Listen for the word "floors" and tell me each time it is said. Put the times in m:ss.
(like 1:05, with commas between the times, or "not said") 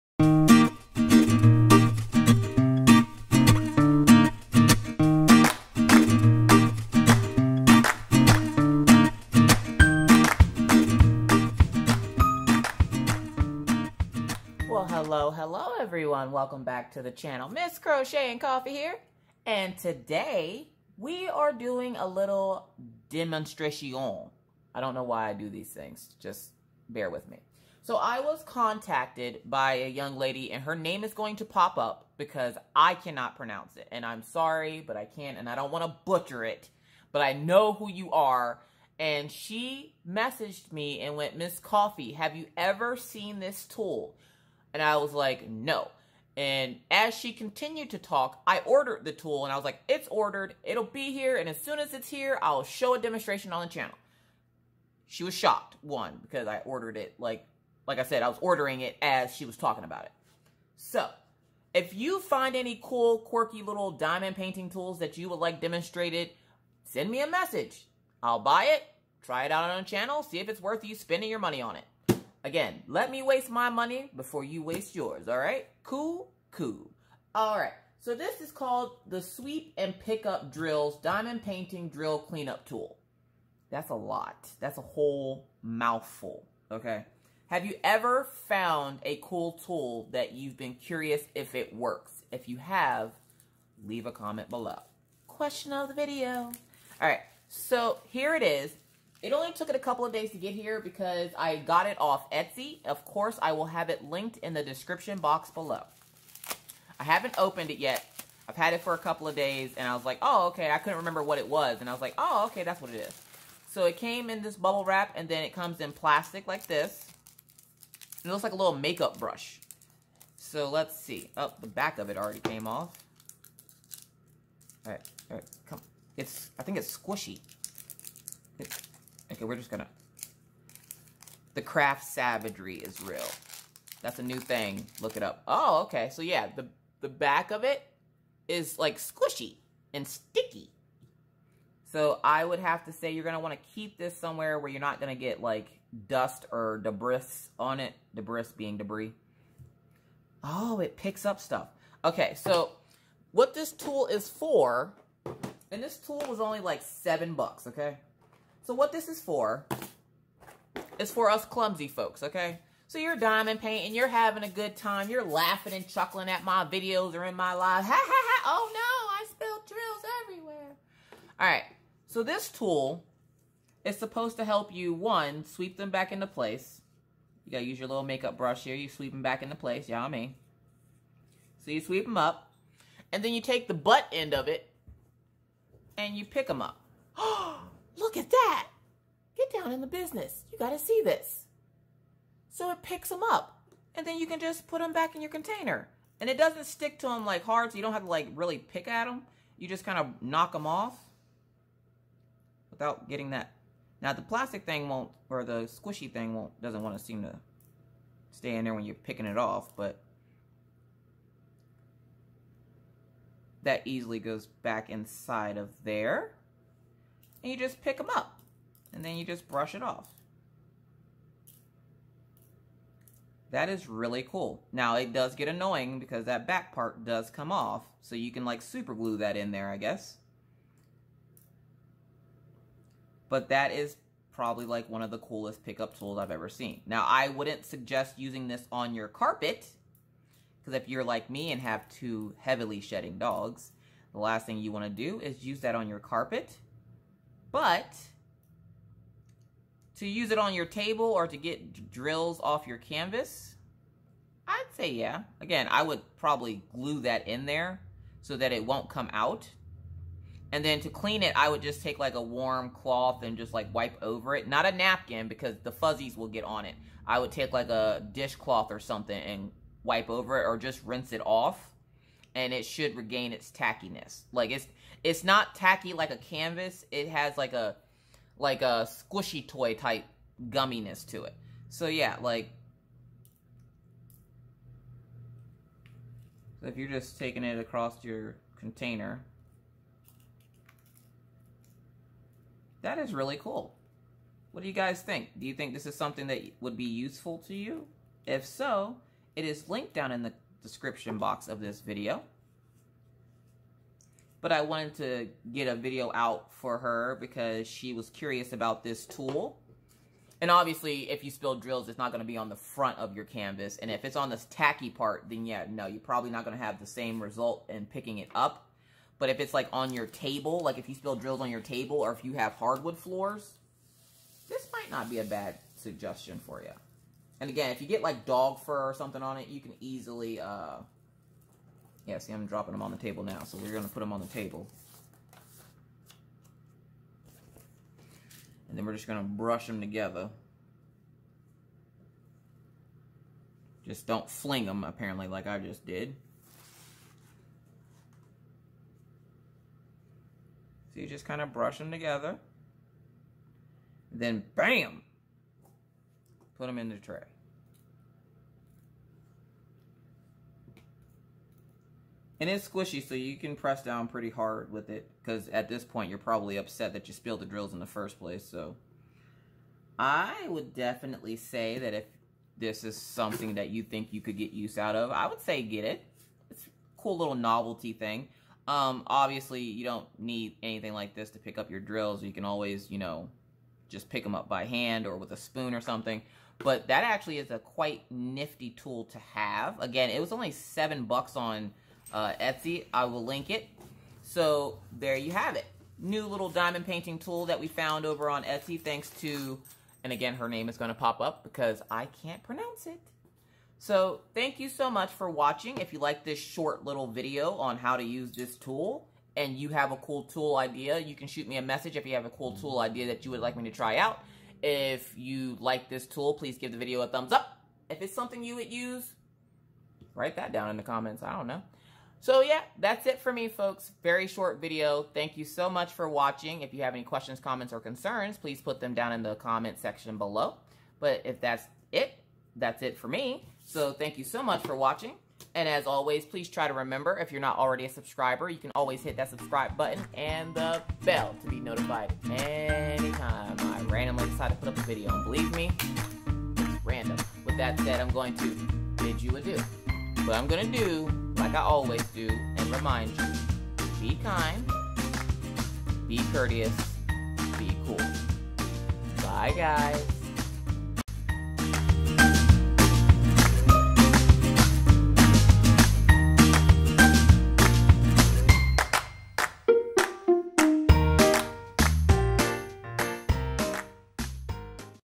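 5:22.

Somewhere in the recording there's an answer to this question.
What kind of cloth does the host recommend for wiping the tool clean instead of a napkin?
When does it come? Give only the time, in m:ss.
4:28.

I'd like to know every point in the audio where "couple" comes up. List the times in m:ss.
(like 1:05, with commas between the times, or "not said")
1:39, 1:48.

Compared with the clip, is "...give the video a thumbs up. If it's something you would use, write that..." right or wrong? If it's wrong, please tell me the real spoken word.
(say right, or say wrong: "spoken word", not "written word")
right.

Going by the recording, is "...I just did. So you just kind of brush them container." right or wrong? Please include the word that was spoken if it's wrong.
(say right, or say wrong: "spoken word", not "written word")
wrong: "together", not "container".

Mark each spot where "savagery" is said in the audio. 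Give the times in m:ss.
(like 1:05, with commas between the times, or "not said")
2:12.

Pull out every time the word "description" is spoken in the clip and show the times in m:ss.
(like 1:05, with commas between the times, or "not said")
1:44, 5:00.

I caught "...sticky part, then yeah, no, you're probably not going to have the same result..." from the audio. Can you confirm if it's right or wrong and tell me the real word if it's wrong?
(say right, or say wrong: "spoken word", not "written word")
wrong: "tacky", not "sticky".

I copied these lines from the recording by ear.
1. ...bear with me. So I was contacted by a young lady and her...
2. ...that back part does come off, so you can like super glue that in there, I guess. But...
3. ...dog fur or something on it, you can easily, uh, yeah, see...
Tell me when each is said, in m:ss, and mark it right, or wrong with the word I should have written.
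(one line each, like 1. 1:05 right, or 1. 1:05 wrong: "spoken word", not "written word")
1. 0:26 right
2. 3:46 right
3. 5:28 right.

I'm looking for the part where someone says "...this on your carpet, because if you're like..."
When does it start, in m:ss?
3:58.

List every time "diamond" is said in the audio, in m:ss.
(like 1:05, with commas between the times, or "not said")
1:03, 1:21, 2:43, 6:36.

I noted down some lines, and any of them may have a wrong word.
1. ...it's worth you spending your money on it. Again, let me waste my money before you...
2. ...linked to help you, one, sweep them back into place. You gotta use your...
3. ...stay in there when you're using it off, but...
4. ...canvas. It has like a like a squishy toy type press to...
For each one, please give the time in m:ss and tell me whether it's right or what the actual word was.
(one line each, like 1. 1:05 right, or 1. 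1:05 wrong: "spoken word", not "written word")
1. 1:10 right
2. 2:53 wrong: "supposed", not "linked"
3. 3:28 wrong: "picking", not "using"
4. 4:36 wrong: "gumminess", not "press".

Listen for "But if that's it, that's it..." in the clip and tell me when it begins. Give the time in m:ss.
7:10.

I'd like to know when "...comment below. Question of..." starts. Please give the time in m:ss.
1:34.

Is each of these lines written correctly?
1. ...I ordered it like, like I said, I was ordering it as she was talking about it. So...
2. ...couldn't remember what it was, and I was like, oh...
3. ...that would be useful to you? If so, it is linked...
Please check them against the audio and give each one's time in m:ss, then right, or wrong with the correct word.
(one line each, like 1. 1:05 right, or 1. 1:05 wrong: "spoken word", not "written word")
1. 0:56 right
2. 1:50 right
3. 4:56 right.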